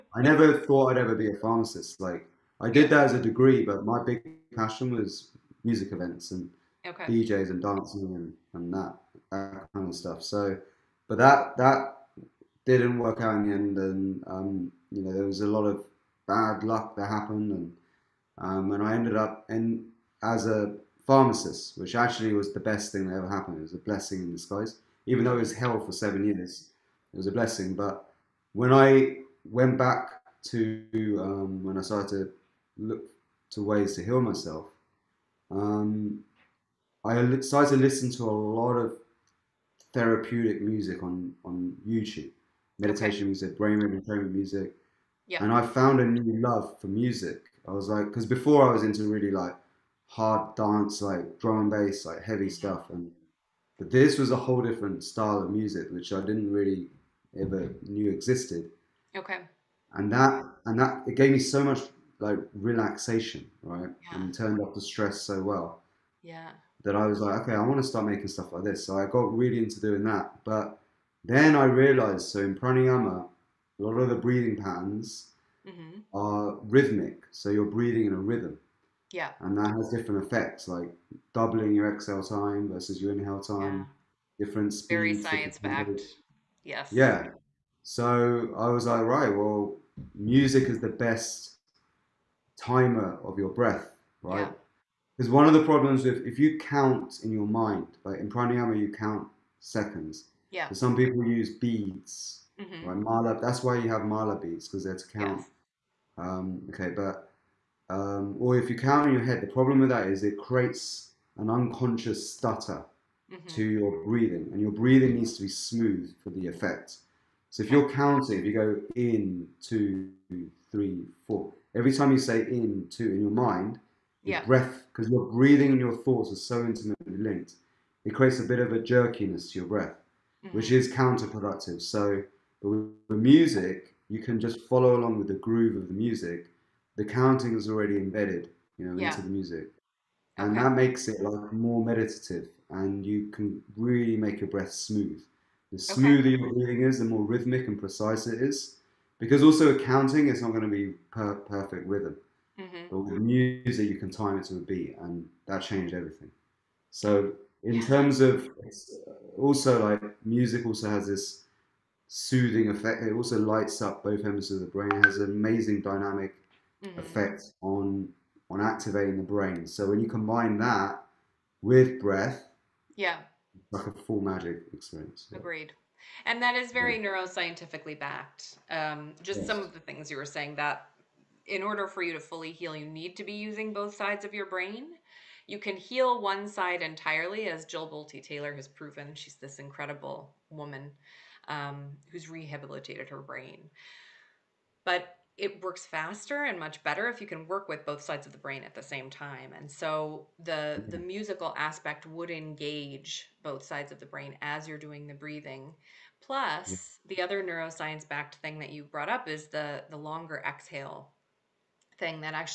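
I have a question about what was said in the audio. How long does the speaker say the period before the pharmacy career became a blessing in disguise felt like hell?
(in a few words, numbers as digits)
7 years.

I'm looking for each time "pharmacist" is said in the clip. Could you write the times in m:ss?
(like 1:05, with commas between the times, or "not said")
0:01, 0:21.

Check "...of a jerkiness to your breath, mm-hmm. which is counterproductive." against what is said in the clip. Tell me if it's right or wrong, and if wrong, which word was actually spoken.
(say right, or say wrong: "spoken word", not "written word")
right.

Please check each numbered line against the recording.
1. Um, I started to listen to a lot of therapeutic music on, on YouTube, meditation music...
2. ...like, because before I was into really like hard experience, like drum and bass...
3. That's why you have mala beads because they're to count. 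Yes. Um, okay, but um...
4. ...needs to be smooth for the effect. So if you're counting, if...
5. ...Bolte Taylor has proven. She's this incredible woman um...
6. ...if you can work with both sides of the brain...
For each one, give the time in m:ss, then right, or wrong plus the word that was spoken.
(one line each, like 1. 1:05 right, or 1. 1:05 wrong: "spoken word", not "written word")
1. 0:35 right
2. 0:47 wrong: "dance", not "experience"
3. 1:43 right
4. 1:55 right
5. 3:07 right
6. 3:17 right.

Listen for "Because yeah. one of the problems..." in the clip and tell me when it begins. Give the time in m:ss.
1:35.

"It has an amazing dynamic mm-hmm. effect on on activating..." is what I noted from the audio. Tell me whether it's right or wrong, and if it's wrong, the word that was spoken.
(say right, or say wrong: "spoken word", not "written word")
right.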